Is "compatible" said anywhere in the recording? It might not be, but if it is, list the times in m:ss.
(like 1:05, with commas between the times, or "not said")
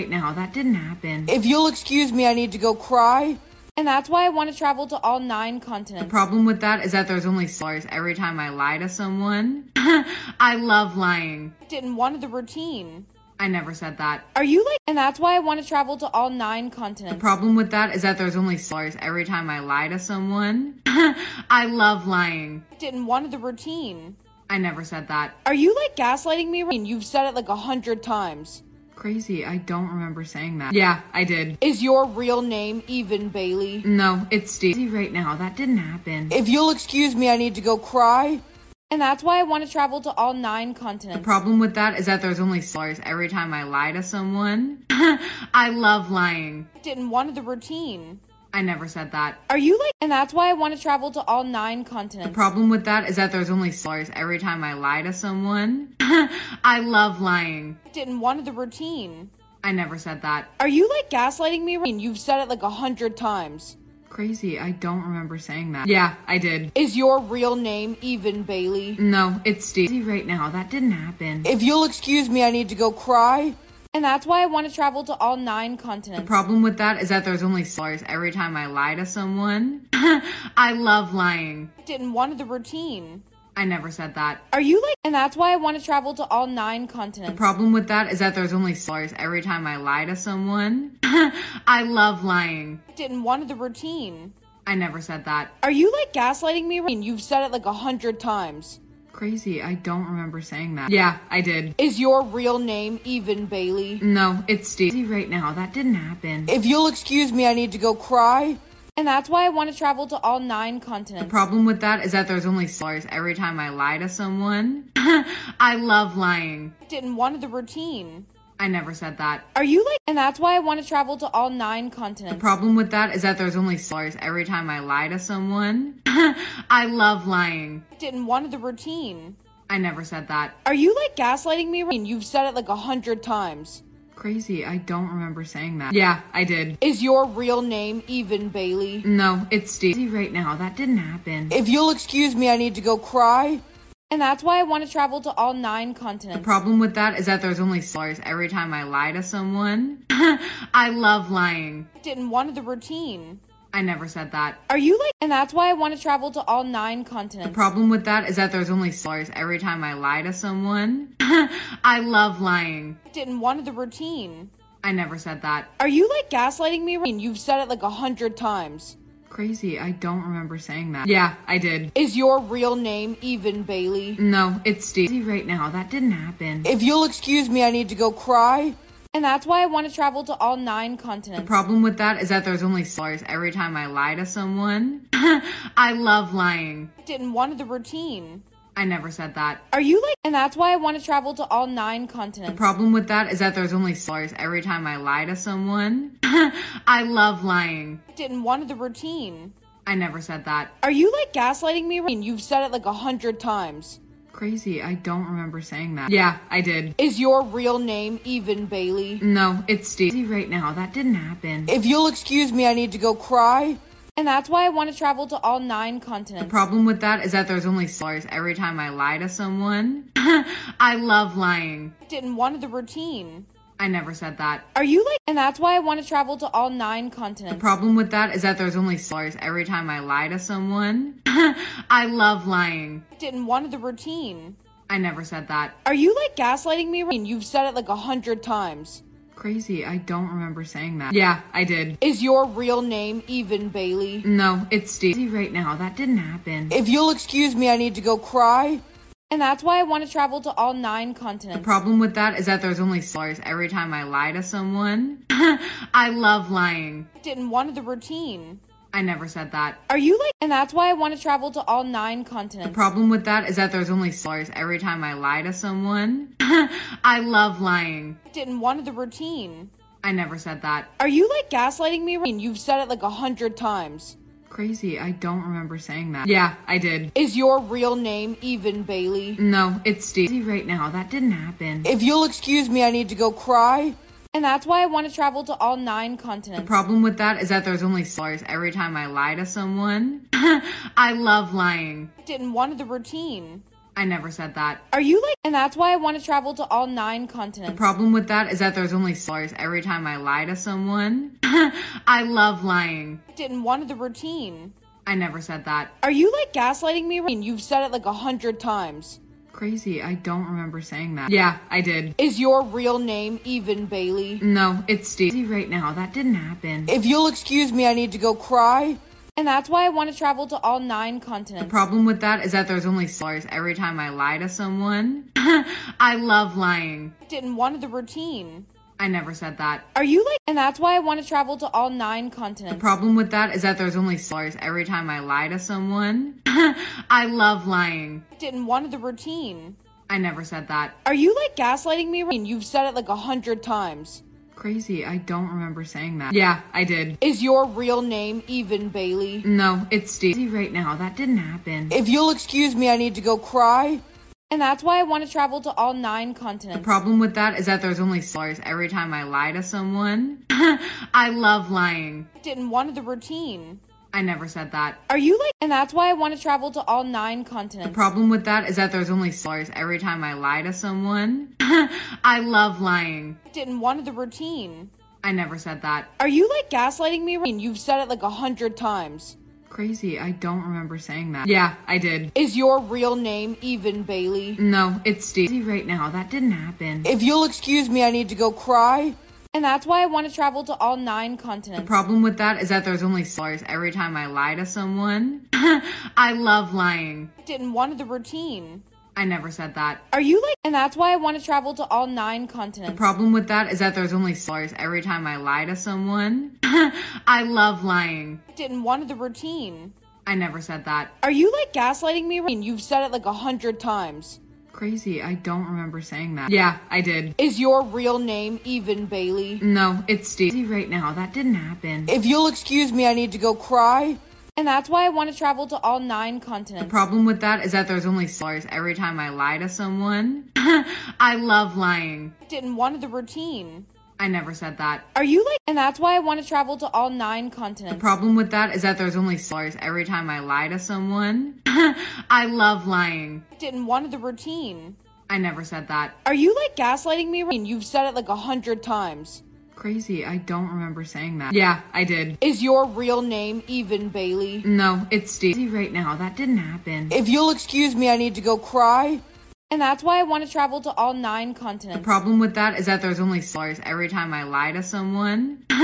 not said.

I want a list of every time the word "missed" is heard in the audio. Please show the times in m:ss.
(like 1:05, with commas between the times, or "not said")
not said.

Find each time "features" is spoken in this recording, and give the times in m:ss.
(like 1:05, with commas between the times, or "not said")
not said.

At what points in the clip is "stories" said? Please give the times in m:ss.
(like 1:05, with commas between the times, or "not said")
1:28, 3:48, 4:59, 6:09, 7:19.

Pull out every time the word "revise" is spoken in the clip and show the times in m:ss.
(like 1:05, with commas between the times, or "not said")
not said.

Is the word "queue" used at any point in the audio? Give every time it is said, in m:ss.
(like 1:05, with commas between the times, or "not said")
not said.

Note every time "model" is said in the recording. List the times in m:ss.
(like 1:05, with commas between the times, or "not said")
not said.